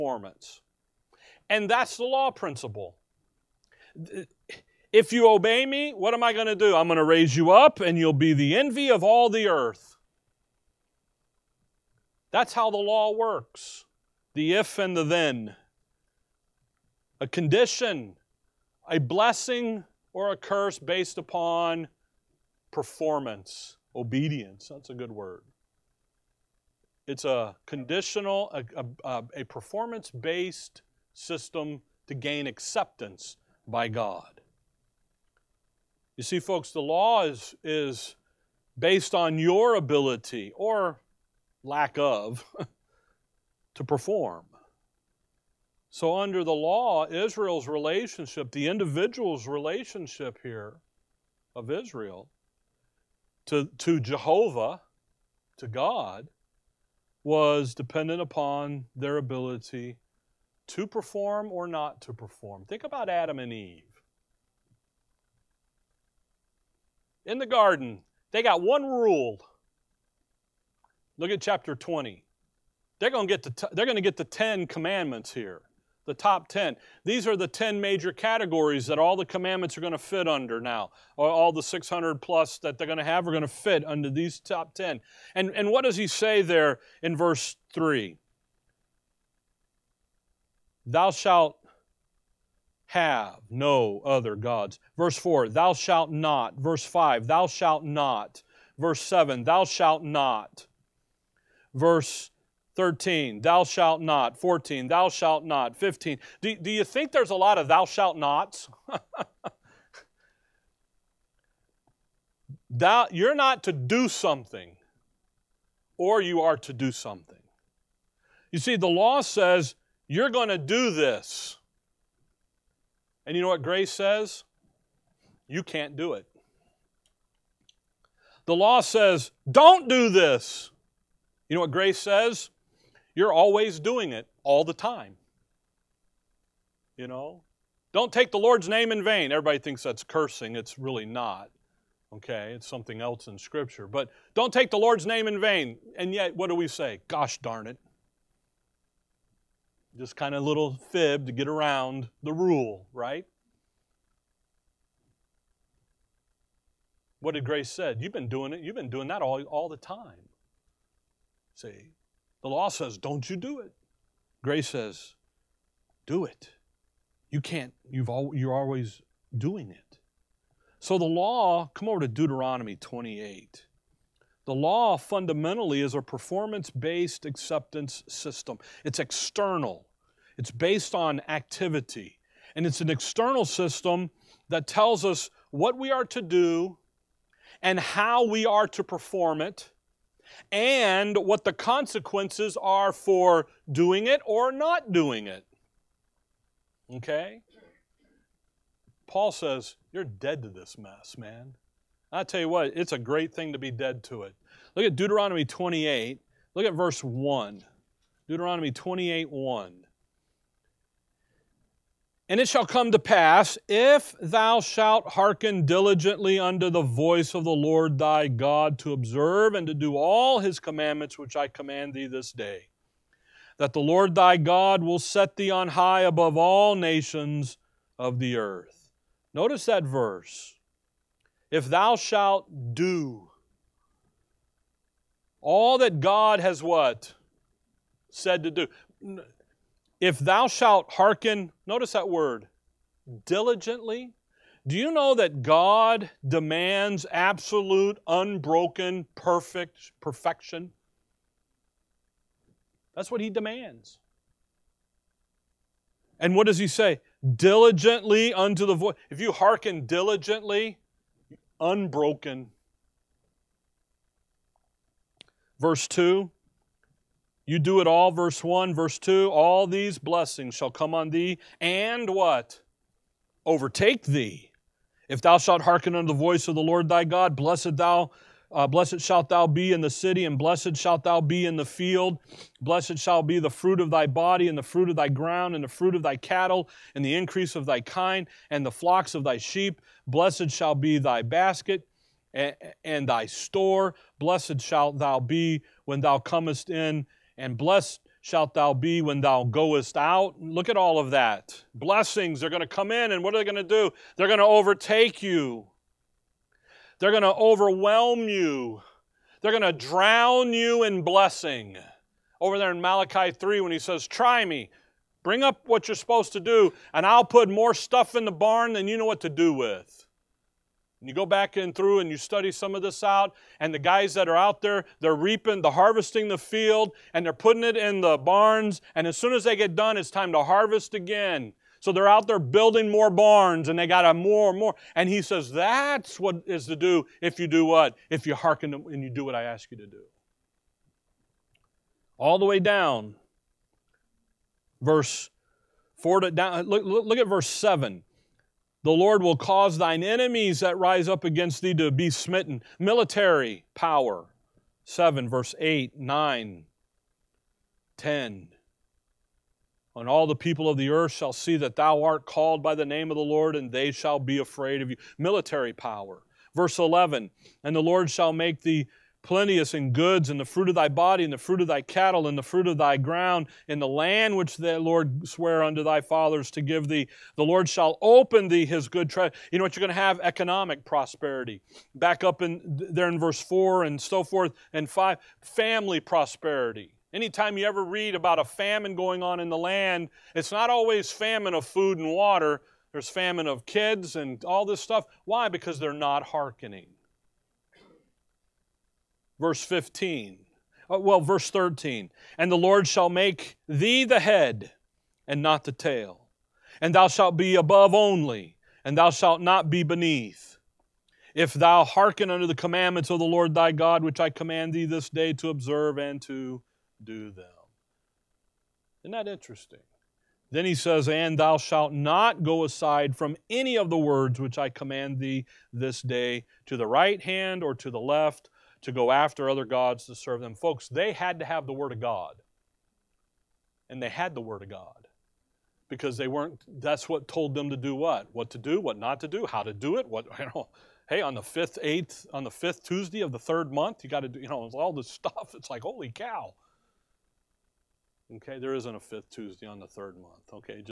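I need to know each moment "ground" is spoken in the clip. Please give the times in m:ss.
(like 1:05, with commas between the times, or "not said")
4:45, 6:12.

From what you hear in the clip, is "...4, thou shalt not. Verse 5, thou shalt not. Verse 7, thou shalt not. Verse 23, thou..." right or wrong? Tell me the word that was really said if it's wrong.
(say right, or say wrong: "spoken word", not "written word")
wrong: "13", not "23".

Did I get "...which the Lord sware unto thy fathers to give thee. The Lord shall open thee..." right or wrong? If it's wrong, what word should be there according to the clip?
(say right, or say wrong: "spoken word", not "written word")
right.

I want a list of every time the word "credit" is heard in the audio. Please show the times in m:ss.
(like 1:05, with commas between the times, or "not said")
not said.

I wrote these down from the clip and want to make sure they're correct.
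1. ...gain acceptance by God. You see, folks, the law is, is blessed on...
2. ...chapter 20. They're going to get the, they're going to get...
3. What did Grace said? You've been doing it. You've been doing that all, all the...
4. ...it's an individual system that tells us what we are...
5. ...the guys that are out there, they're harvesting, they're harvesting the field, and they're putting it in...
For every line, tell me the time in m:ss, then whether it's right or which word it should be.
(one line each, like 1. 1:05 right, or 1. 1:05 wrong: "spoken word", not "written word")
1. 0:32 wrong: "based", not "blessed"
2. 1:11 right
3. 2:37 right
4. 3:02 wrong: "external", not "individual"
5. 5:23 wrong: "reaping", not "harvesting".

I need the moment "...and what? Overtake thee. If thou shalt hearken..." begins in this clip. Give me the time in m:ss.
4:31.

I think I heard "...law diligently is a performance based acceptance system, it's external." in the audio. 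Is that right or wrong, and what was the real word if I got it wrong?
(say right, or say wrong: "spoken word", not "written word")
wrong: "fundamentally", not "diligently".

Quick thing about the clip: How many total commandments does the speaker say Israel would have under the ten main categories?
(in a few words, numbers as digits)
600 plus.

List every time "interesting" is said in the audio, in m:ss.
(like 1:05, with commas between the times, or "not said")
6:59.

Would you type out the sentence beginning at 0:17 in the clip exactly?
A condition, a blessing, or a curse based upon performance, obedience.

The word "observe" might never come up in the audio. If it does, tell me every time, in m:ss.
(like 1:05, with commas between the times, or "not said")
3:38, 6:55.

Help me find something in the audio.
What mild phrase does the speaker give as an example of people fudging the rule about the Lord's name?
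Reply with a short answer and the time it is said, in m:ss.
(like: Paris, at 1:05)
Gosh darn it, at 2:27.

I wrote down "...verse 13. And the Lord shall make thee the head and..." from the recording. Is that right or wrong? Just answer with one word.
right.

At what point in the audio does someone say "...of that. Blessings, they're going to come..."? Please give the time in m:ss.
5:00.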